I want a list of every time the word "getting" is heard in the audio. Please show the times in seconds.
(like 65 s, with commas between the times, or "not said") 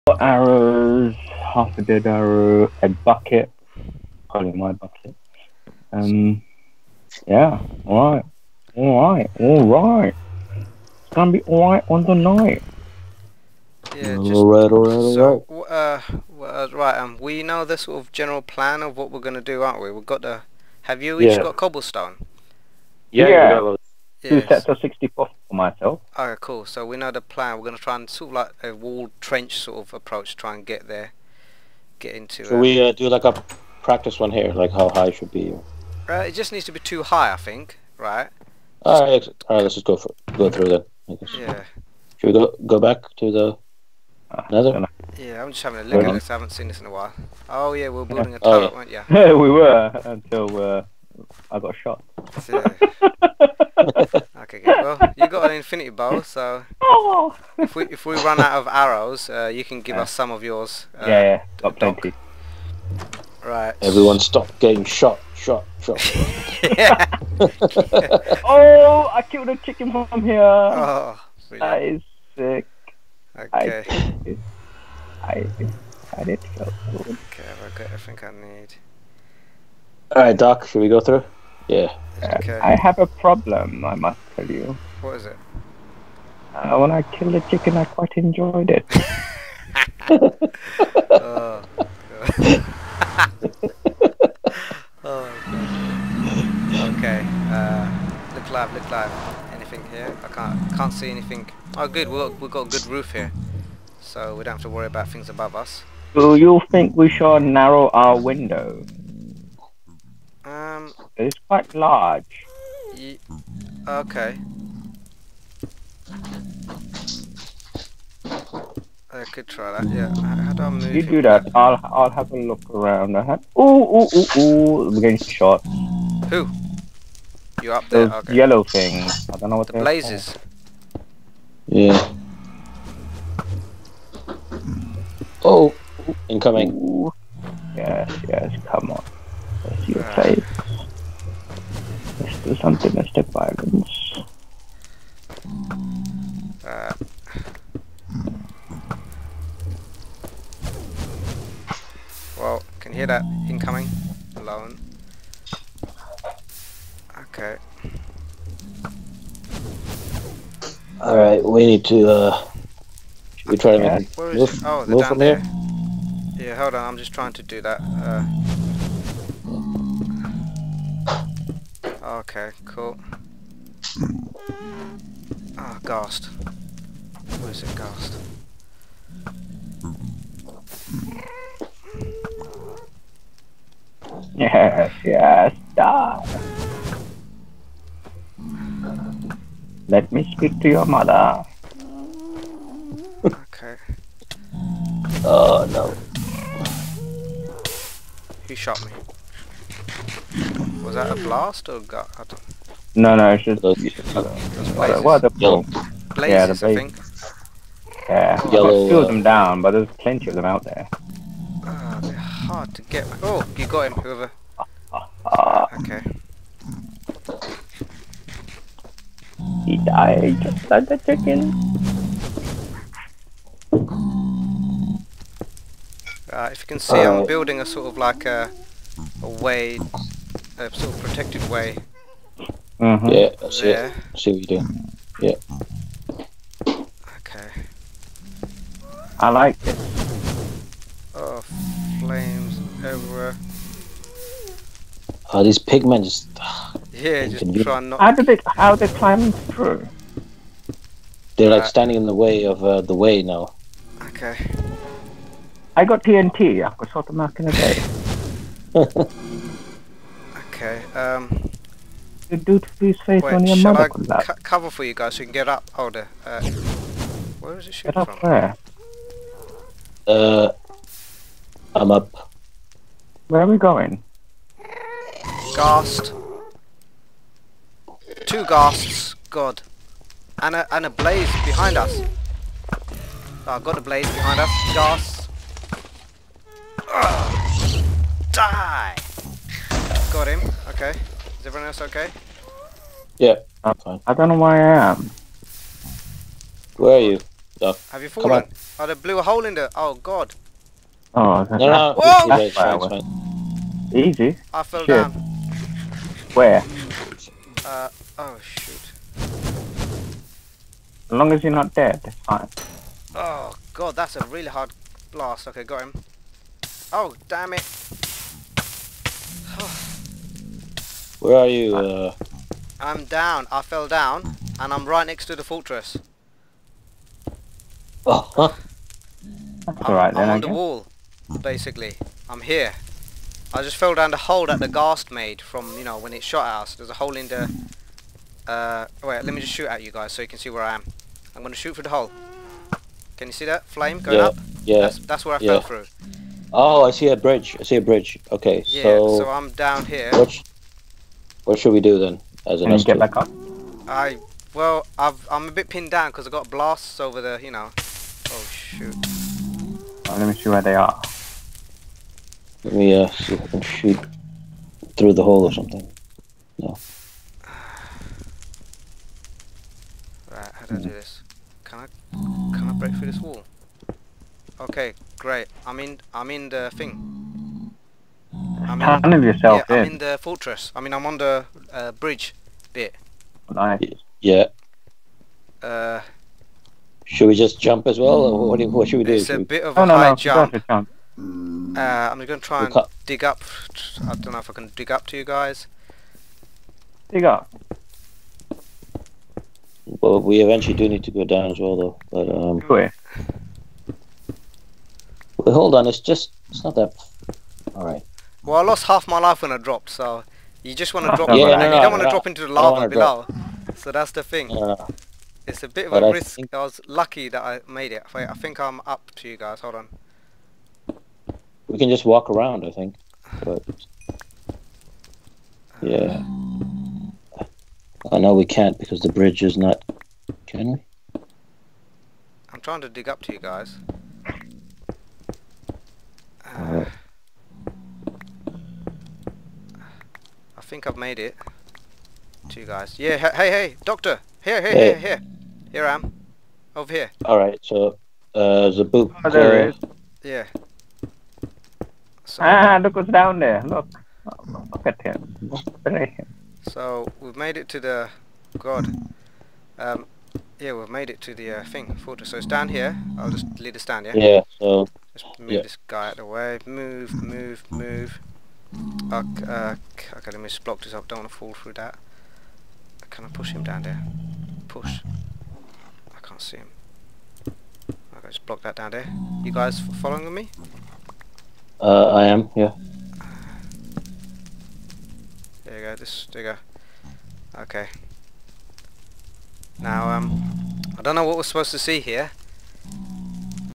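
64 s, 125 s.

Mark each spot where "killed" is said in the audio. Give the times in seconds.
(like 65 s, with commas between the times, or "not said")
69 s, 87 s, 208 s.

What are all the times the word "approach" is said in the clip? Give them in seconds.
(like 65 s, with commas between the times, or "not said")
29 s.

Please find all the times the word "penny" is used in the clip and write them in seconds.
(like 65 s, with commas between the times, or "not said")
not said.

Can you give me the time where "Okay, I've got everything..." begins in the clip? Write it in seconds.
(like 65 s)
76 s.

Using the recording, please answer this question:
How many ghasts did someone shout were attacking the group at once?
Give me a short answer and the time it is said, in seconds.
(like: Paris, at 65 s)
2, at 278 s.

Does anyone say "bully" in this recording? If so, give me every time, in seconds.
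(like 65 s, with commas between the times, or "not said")
not said.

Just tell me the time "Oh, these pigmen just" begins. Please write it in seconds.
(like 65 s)
245 s.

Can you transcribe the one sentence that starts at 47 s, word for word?
Oh yeah, we were building a oh, turret, oh, yeah.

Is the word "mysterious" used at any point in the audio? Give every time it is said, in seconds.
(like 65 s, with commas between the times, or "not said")
not said.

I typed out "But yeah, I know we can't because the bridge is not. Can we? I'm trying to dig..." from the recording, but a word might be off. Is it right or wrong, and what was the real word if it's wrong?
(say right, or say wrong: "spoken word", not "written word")
right.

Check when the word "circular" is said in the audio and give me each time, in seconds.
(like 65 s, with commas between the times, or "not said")
not said.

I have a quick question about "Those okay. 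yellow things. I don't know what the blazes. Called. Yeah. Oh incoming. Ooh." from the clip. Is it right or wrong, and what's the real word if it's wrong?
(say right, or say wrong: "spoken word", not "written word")
right.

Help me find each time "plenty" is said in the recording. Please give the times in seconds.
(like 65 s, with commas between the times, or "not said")
61 s, 209 s.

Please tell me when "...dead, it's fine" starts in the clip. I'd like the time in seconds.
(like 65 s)
311 s.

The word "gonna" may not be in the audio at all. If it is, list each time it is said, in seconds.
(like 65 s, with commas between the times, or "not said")
11 s, 19 s.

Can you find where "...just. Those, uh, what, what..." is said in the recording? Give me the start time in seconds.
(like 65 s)
203 s.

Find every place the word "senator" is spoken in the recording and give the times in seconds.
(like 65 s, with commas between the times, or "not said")
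not said.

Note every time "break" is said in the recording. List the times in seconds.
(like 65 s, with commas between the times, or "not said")
372 s.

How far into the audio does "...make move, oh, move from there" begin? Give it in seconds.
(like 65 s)
164 s.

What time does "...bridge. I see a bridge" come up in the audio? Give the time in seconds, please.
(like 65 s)
347 s.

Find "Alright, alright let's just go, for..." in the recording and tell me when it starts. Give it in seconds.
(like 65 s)
38 s.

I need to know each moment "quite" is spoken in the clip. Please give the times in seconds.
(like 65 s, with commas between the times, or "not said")
87 s, 111 s.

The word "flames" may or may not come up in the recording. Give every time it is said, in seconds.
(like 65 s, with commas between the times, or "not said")
242 s, 343 s.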